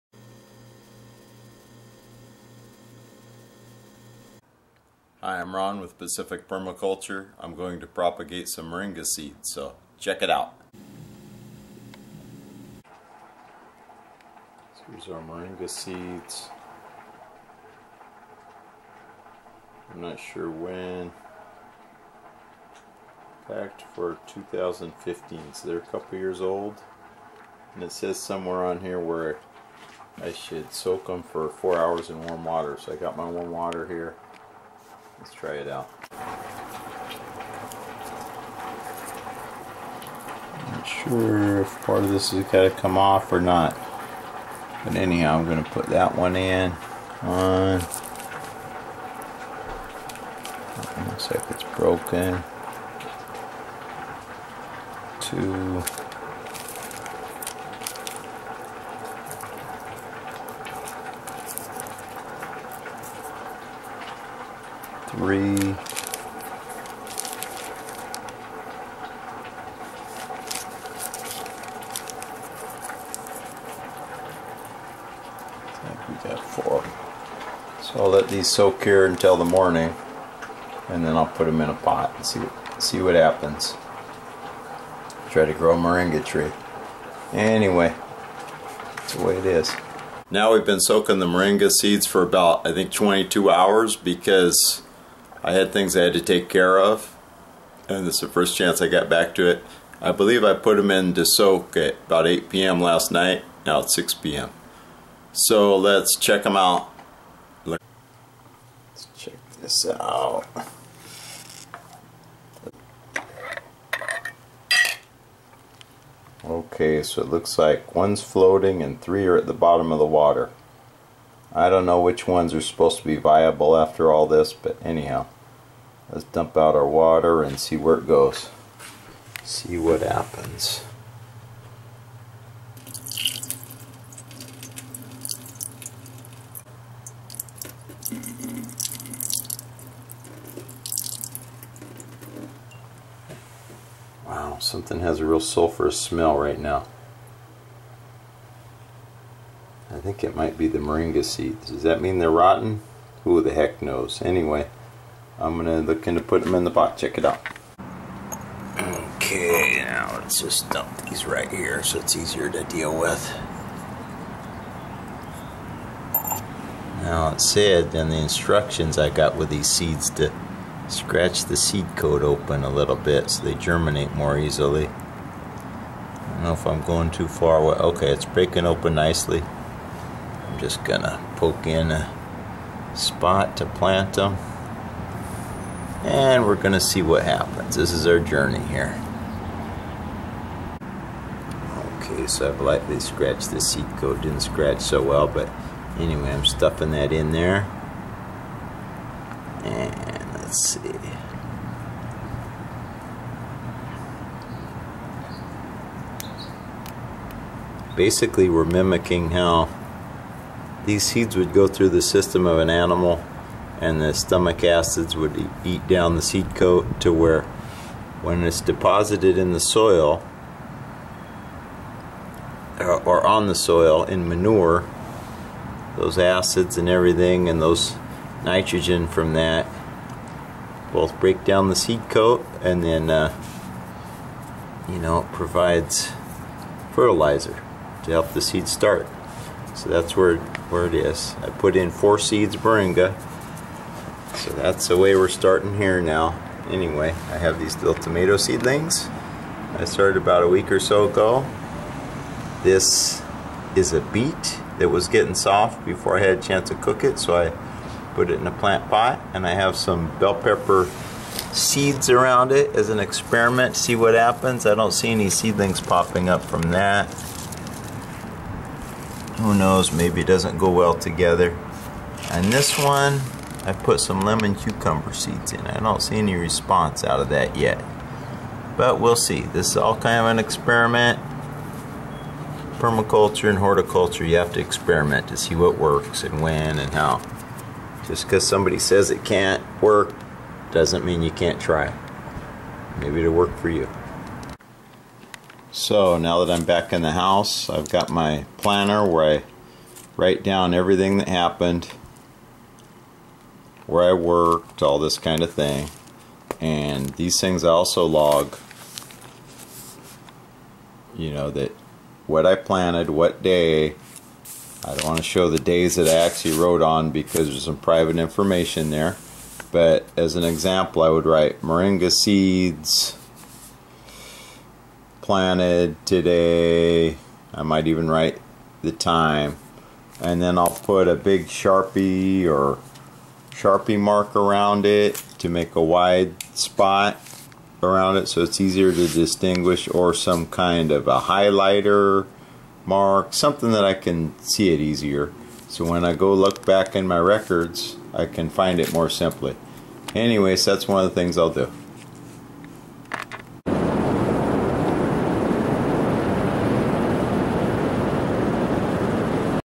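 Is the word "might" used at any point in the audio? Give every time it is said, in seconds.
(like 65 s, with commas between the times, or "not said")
150 s, 327 s.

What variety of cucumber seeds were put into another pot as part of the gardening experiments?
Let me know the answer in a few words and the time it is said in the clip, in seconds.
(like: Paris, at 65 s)
lemon cucumber, at 274 s.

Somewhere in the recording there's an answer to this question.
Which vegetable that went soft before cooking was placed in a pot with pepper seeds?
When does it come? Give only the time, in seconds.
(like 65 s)
254 s.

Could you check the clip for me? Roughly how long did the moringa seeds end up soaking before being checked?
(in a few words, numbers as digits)
22 hours.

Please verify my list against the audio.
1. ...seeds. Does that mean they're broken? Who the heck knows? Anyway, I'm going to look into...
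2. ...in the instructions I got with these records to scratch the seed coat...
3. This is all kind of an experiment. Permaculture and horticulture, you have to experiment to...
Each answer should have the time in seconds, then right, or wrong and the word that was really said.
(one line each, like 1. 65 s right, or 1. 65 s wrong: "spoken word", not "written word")
1. 151 s wrong: "rotten", not "broken"
2. 167 s wrong: "seeds", not "records"
3. 279 s right.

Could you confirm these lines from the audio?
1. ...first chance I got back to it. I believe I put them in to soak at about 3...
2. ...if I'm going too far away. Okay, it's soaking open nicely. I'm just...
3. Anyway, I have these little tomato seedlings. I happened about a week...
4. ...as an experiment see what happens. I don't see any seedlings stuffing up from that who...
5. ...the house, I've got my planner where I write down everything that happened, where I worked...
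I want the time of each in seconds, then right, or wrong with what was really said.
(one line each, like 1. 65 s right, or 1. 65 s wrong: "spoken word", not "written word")
1. 98 s wrong: "8", not "3"
2. 176 s wrong: "breaking", not "soaking"
3. 246 s wrong: "started", not "happened"
4. 262 s wrong: "popping", not "stuffing"
5. 297 s right.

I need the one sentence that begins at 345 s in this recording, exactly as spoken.
So when I go look back in my records, I can find it more simply.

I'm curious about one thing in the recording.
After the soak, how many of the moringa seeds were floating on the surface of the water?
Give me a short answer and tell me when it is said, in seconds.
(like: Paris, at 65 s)
1, at 117 s.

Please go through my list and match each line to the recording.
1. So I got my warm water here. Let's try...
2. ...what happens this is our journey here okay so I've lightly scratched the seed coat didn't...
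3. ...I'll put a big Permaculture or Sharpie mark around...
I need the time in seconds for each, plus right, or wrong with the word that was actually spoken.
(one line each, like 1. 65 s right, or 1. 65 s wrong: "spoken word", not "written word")
1. 32 s right
2. 187 s right
3. 330 s wrong: "Sharpie", not "Permaculture".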